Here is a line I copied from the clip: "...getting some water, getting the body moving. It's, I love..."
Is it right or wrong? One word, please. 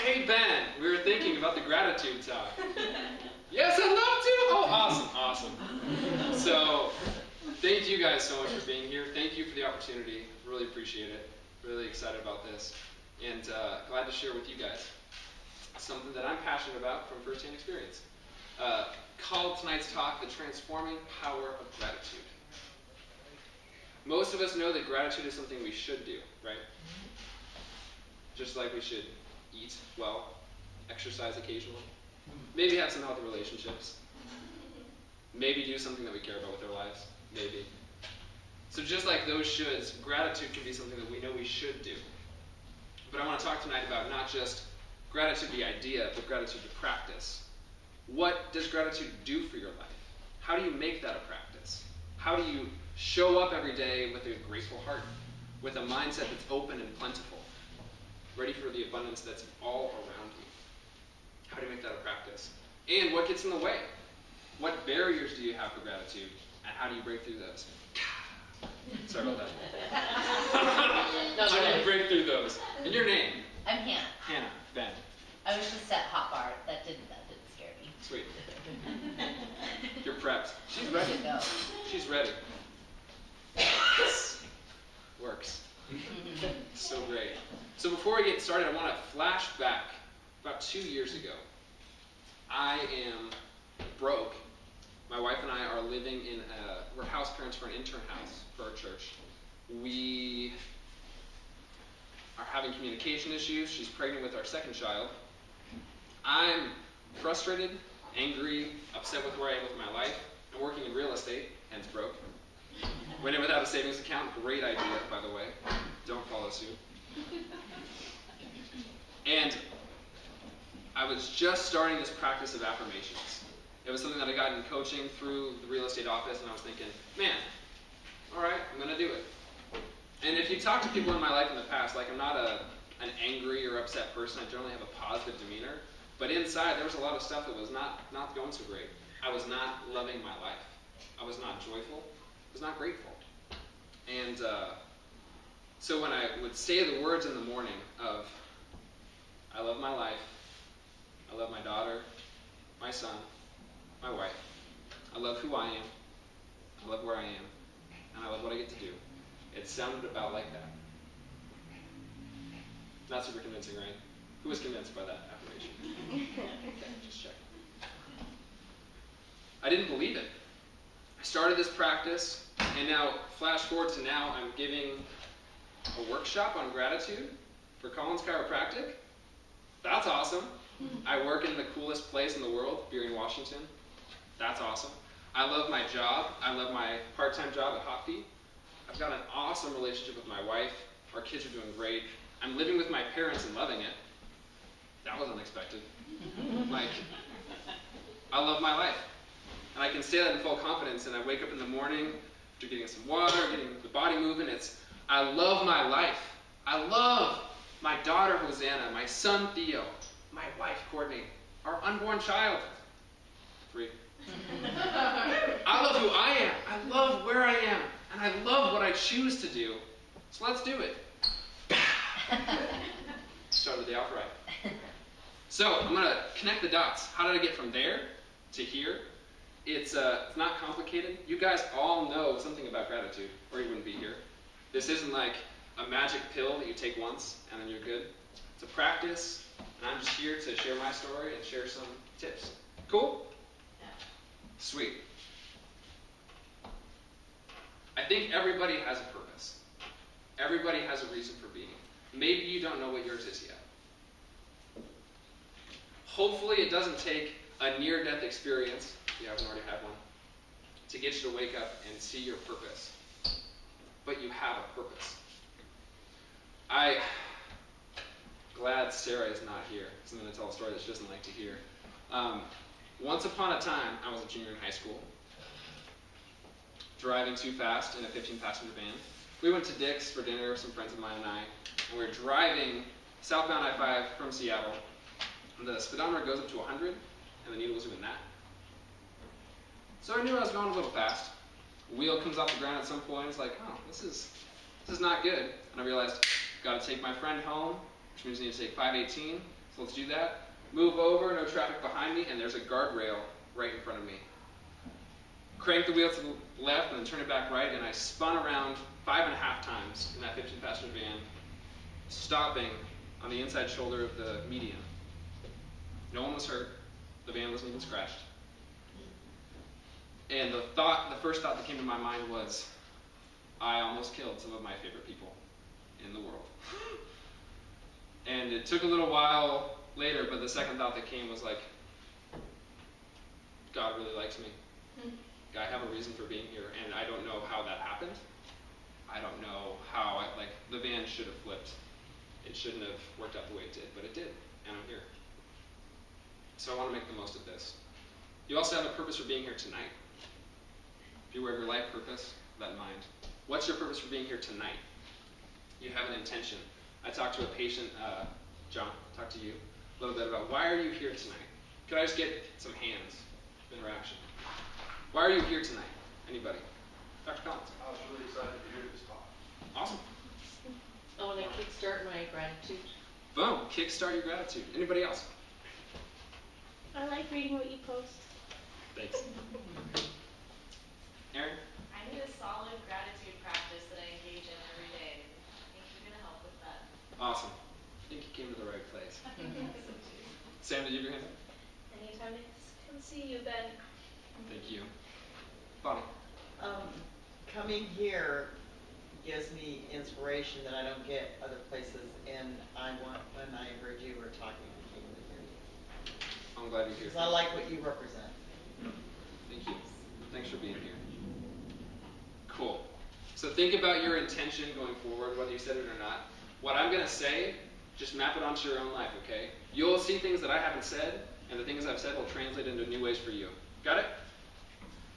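right.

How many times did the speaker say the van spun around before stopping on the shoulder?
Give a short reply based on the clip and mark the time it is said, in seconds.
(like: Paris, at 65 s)
5.5, at 309 s.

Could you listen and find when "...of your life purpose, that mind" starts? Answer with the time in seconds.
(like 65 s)
351 s.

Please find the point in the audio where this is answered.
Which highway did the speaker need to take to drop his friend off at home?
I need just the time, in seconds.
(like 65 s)
298 s.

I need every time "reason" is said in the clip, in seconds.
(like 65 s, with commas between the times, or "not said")
251 s, 335 s.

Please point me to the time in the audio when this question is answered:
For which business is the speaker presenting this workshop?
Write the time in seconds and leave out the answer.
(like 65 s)
177 s.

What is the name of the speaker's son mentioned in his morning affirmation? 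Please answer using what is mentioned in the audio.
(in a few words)
Theo.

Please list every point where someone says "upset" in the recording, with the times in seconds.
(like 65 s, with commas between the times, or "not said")
108 s, 133 s.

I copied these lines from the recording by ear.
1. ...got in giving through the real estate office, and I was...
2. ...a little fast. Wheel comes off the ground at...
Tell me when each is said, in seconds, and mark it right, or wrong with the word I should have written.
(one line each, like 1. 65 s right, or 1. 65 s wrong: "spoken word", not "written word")
1. 124 s wrong: "coaching", not "giving"
2. 290 s right.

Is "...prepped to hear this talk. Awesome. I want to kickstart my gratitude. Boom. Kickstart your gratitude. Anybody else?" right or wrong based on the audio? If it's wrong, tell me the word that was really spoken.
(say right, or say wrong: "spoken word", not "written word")
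wrong: "excited", not "prepped".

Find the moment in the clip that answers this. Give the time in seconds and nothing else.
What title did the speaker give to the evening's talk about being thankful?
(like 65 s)
20 s.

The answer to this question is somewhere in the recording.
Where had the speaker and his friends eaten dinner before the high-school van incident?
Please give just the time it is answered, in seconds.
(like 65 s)
279 s.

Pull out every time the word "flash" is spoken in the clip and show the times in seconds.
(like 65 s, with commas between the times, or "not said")
89 s, 173 s.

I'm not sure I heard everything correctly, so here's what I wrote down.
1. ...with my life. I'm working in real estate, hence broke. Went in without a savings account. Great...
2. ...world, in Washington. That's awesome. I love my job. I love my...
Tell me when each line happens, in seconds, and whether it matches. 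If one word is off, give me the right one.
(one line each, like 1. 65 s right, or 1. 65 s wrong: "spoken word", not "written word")
1. 109 s right
2. 182 s right.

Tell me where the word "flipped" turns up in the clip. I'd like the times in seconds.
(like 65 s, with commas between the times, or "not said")
341 s.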